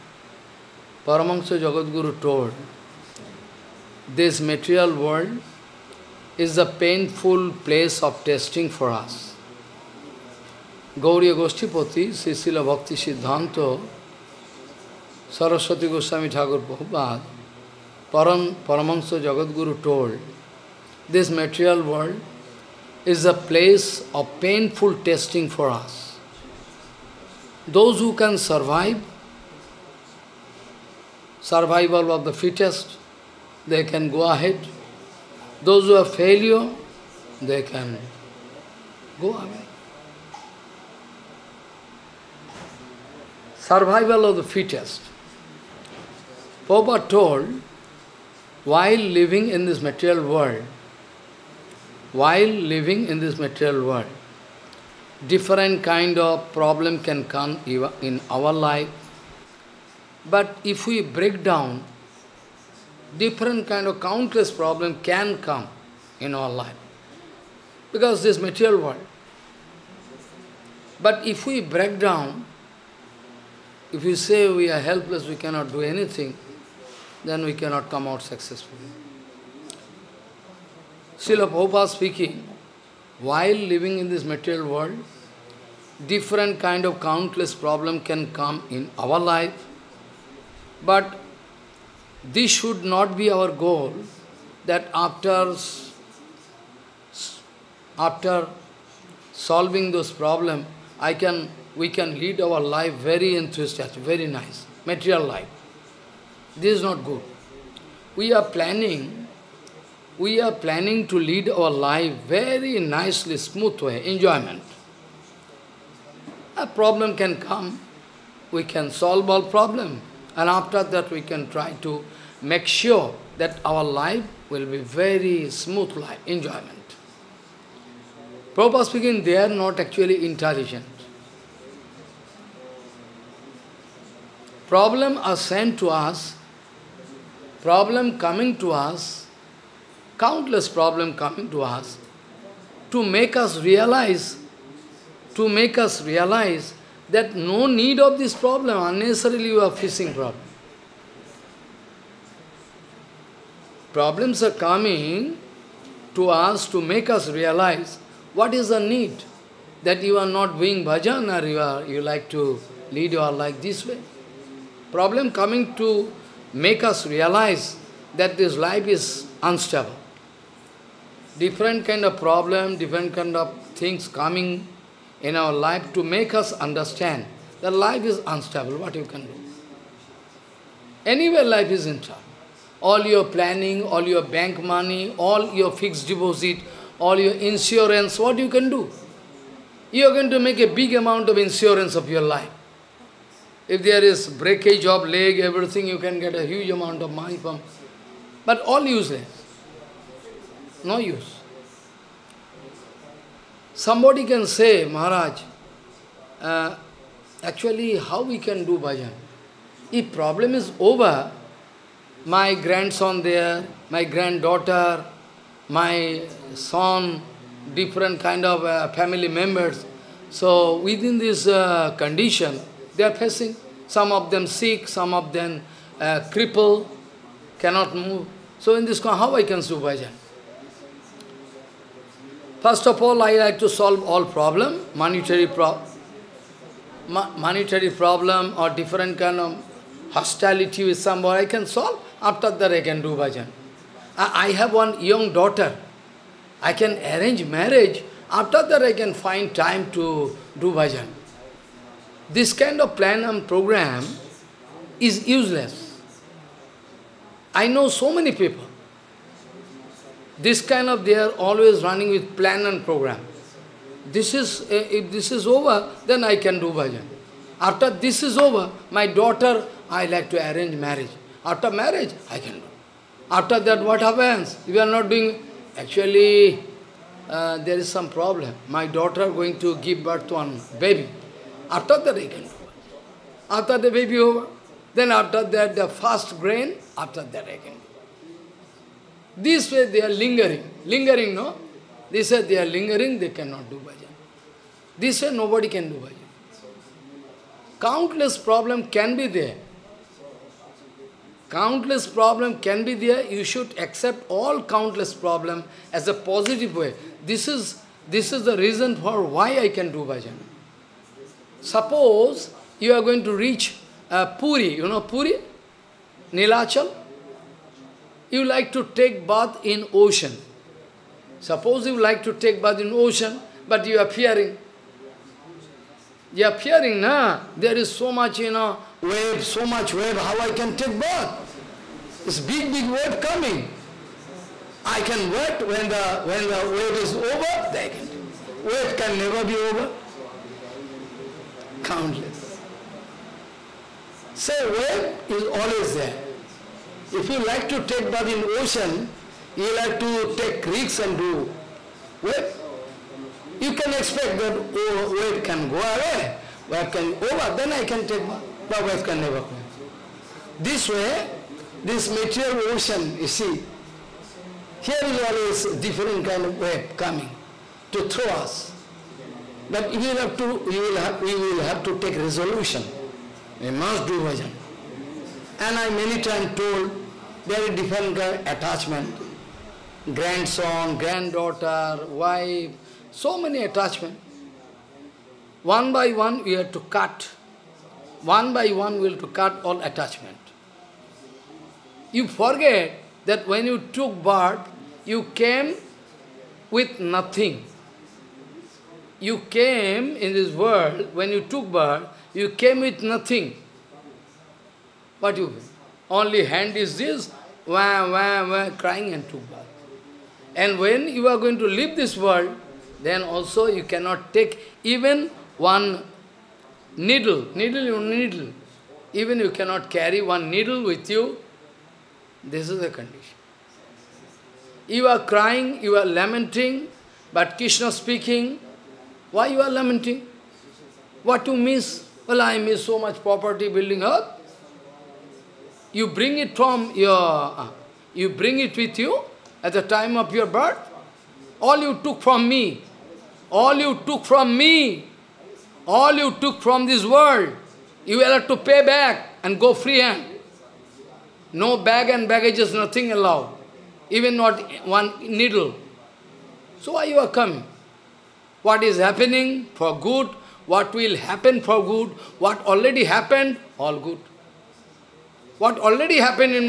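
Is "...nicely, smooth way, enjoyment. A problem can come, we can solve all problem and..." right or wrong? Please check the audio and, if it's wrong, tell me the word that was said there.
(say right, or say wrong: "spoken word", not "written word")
right.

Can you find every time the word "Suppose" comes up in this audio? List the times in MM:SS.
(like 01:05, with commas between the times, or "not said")
05:11, 05:21.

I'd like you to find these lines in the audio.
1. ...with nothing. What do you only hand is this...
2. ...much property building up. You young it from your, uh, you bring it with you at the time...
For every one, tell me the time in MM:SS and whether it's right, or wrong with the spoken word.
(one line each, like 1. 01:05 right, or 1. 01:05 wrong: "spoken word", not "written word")
1. 06:42 right
2. 07:12 wrong: "bring", not "young".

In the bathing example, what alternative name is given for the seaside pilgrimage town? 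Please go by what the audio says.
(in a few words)
Nilachal.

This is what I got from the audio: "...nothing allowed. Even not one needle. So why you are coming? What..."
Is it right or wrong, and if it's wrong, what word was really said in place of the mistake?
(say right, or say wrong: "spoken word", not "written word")
right.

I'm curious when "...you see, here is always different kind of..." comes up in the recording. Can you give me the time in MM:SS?
06:03.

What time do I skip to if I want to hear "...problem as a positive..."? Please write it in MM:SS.
05:05.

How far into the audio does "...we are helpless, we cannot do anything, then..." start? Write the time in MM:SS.
01:14.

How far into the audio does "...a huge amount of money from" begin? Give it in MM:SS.
03:16.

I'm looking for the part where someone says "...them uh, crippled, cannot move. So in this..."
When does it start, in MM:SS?
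03:45.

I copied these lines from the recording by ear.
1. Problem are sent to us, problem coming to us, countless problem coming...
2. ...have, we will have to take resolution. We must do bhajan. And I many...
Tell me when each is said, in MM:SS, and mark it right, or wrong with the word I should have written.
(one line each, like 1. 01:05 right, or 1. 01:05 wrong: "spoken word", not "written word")
1. 02:14 right
2. 06:11 right.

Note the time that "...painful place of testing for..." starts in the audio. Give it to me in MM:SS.
00:06.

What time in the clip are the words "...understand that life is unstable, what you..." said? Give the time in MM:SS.
02:56.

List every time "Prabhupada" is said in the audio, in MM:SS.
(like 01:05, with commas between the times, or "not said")
00:16, 00:46, 01:21, 02:08.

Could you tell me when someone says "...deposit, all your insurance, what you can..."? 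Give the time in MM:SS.
03:06.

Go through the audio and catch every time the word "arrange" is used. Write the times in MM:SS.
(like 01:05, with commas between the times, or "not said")
04:07, 04:30.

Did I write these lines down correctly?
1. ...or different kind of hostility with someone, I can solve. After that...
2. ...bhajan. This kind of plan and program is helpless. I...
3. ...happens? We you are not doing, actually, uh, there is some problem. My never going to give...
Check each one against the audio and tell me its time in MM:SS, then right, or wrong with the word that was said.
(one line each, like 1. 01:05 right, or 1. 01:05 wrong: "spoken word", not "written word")
1. 03:58 right
2. 04:10 wrong: "useless", not "helpless"
3. 04:34 wrong: "daughter", not "never".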